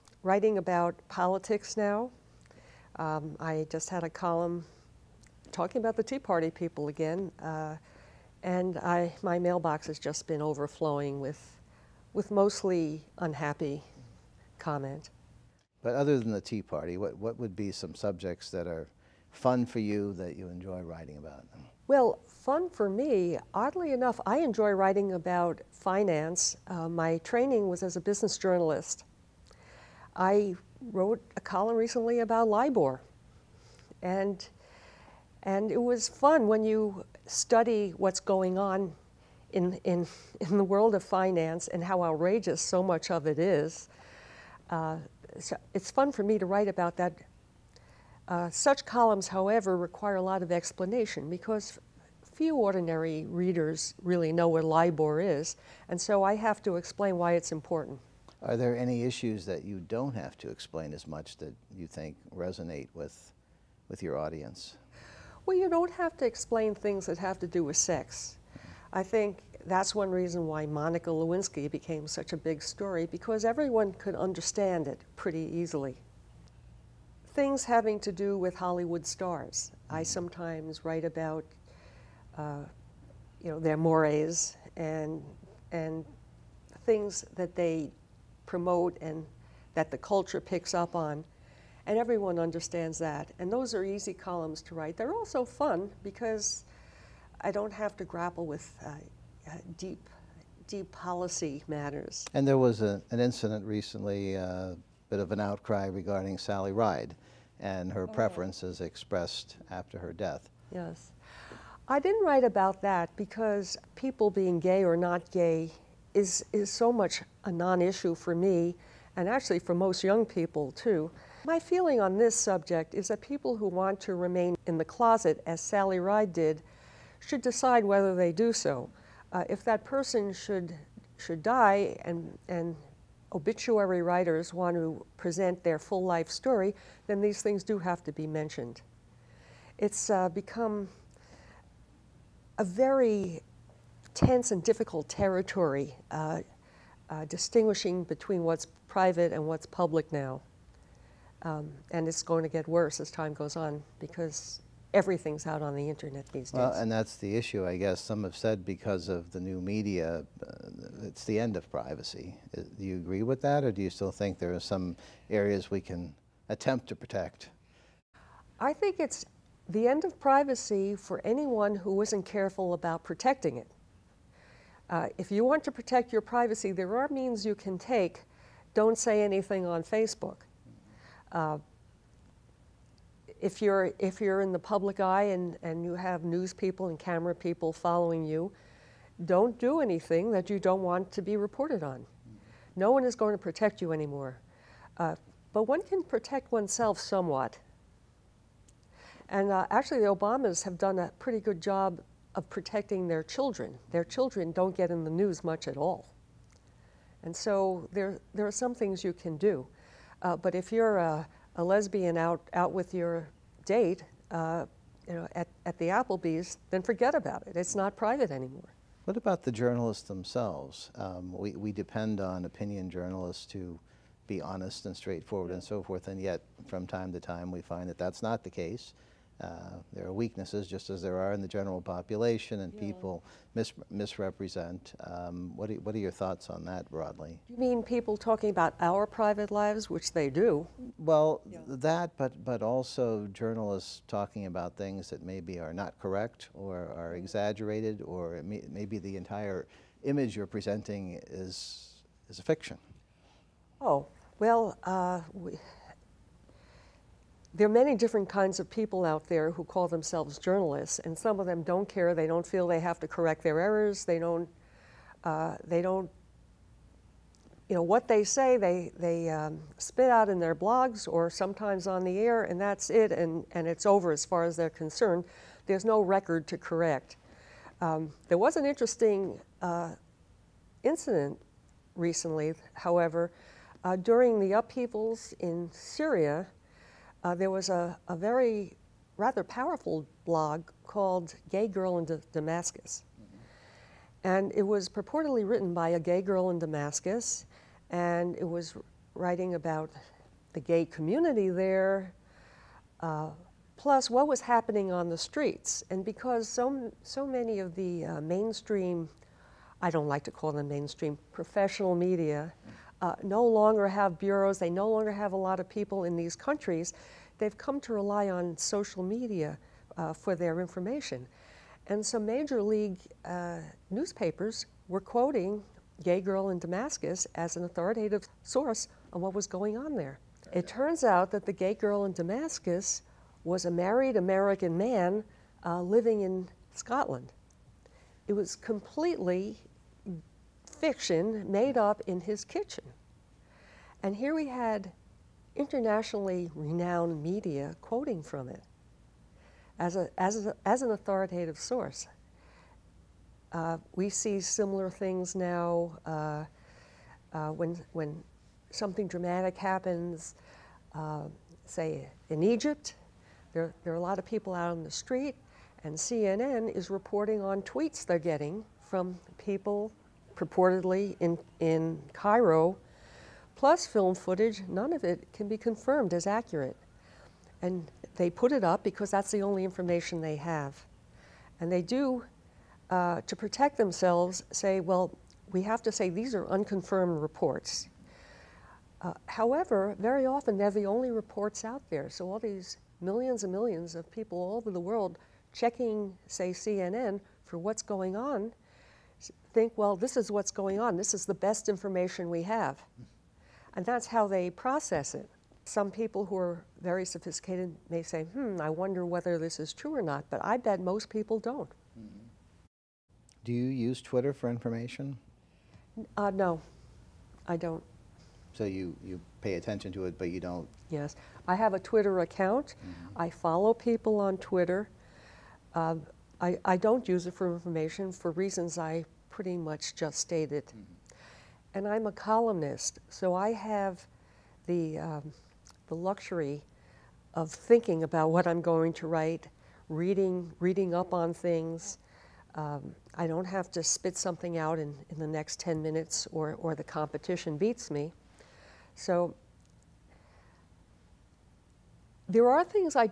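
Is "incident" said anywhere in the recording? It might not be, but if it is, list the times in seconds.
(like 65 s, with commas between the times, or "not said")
103 s, 280 s.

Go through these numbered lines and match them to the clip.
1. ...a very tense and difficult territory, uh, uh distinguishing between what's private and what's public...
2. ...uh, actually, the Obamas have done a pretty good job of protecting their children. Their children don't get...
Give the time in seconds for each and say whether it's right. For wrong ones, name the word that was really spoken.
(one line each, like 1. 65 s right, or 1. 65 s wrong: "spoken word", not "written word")
1. 142 s right
2. 199 s right.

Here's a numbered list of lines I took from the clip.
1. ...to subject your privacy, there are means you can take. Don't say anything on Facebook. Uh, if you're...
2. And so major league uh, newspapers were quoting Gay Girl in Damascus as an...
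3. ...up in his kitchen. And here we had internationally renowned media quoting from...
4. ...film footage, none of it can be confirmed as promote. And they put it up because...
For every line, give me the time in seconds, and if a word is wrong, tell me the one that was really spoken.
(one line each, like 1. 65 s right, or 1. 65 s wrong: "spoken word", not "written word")
1. 175 s wrong: "protect", not "subject"
2. 321 s right
3. 341 s right
4. 373 s wrong: "accurate", not "promote".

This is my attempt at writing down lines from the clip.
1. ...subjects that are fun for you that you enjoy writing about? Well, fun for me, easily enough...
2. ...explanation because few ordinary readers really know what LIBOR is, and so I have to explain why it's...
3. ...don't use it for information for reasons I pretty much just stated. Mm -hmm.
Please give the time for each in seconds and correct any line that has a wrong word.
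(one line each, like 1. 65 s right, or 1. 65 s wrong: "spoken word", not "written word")
1. 17 s wrong: "oddly", not "easily"
2. 50 s right
3. 426 s right.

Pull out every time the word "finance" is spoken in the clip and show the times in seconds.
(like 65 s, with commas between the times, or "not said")
25 s, 41 s.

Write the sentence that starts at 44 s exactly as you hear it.
Uh, so it's fun for me to write about that.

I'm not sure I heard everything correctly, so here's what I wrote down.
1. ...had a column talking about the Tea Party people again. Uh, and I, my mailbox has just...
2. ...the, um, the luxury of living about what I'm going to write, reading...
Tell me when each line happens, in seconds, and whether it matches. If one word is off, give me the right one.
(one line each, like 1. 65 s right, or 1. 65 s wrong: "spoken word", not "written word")
1. 3 s right
2. 434 s wrong: "thinking", not "living".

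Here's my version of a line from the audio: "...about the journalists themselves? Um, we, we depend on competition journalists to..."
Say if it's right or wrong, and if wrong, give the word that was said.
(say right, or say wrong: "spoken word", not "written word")
wrong: "opinion", not "competition".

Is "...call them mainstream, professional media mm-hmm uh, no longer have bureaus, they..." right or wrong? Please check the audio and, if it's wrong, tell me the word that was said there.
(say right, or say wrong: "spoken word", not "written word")
right.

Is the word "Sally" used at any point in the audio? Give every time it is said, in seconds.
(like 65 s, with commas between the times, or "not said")
106 s, 125 s.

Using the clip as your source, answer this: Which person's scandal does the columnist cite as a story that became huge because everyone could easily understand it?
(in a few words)
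Monica Lewinsky.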